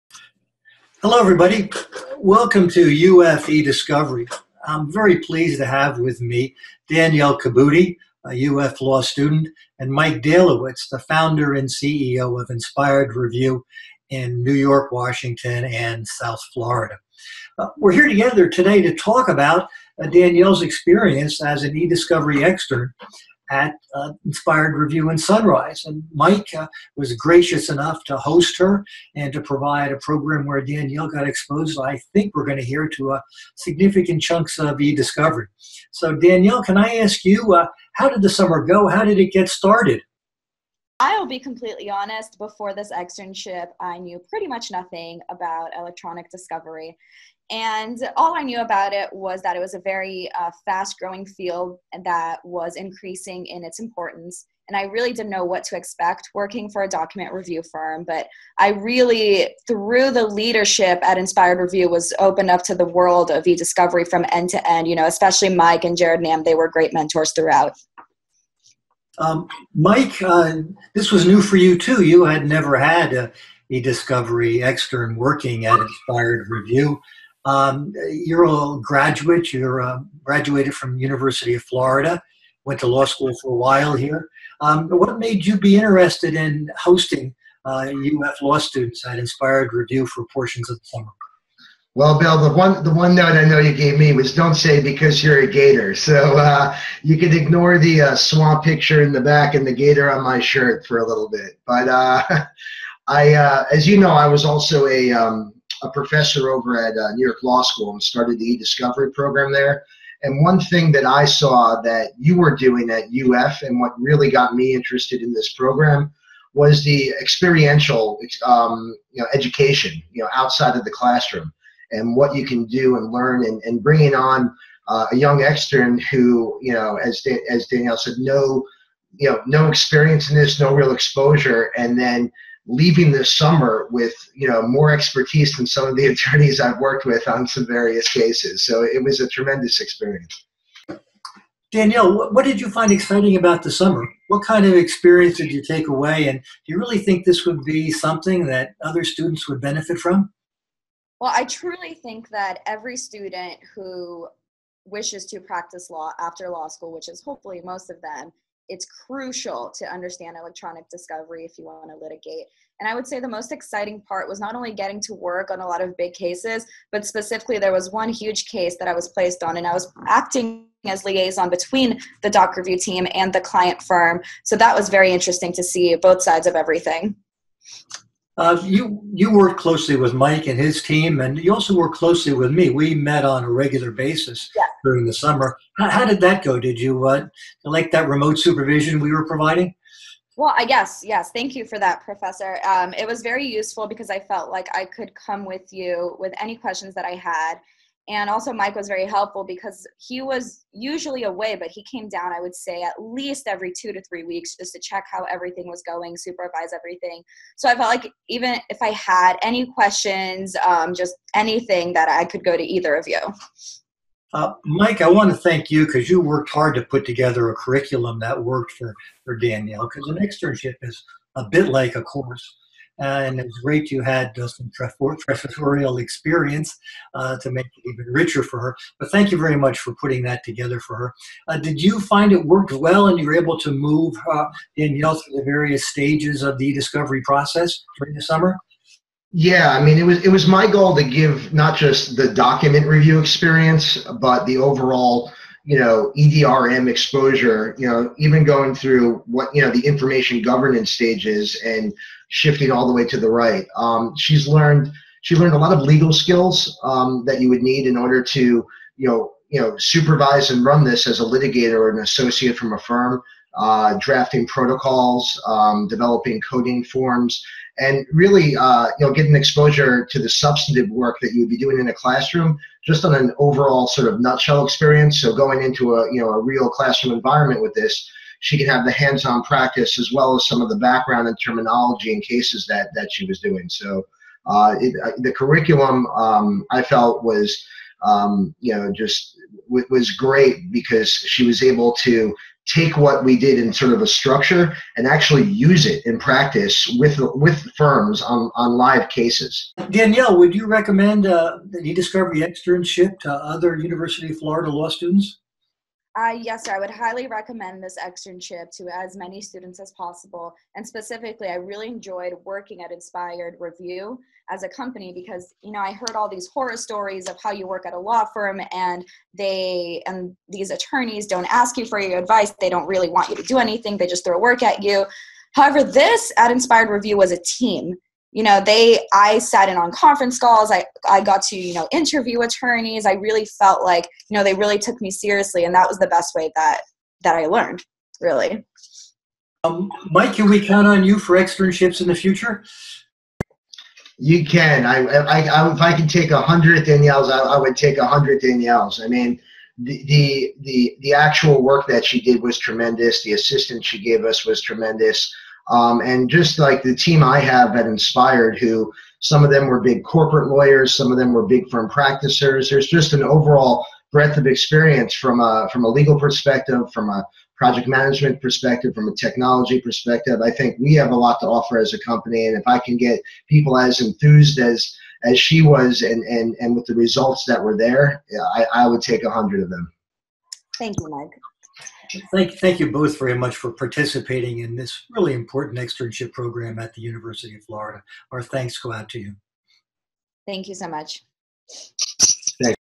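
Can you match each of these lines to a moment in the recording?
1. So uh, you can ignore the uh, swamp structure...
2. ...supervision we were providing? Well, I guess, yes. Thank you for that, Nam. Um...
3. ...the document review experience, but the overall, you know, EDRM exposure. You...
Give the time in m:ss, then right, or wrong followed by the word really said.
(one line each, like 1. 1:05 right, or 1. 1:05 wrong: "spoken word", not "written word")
1. 1:35 wrong: "picture", not "structure"
2. 3:08 wrong: "Professor", not "Nam"
3. 4:02 right.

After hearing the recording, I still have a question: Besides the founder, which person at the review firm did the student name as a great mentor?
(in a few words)
Jared Nam.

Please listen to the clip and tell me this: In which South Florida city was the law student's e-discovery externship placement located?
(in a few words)
Sunrise.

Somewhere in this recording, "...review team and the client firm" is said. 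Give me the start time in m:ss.
2:52.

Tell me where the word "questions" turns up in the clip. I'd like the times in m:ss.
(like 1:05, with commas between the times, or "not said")
3:16, 3:29.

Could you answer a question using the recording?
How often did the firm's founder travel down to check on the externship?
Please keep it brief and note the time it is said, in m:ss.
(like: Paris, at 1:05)
2 to 3 weeks, at 3:23.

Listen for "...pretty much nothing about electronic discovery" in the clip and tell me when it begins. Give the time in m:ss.
0:44.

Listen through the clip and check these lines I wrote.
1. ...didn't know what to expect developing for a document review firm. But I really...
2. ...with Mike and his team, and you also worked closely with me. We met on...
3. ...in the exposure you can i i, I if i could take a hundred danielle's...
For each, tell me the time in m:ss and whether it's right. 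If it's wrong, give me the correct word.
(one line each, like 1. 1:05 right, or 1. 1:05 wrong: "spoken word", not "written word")
1. 0:55 wrong: "working", not "developing"
2. 2:59 right
3. 5:42 wrong: "future", not "exposure".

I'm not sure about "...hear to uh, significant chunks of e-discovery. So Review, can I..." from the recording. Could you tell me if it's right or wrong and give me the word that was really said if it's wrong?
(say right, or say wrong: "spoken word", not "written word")
wrong: "Danielle", not "Review".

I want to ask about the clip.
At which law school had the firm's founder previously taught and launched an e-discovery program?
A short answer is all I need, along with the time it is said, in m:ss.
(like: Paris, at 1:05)
New York Law School, at 1:47.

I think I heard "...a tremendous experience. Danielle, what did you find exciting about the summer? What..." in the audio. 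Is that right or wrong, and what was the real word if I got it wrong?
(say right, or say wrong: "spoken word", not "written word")
right.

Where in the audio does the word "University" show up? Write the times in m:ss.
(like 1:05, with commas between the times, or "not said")
1:20, 5:03, 6:27.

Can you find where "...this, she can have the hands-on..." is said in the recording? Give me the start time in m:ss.
4:37.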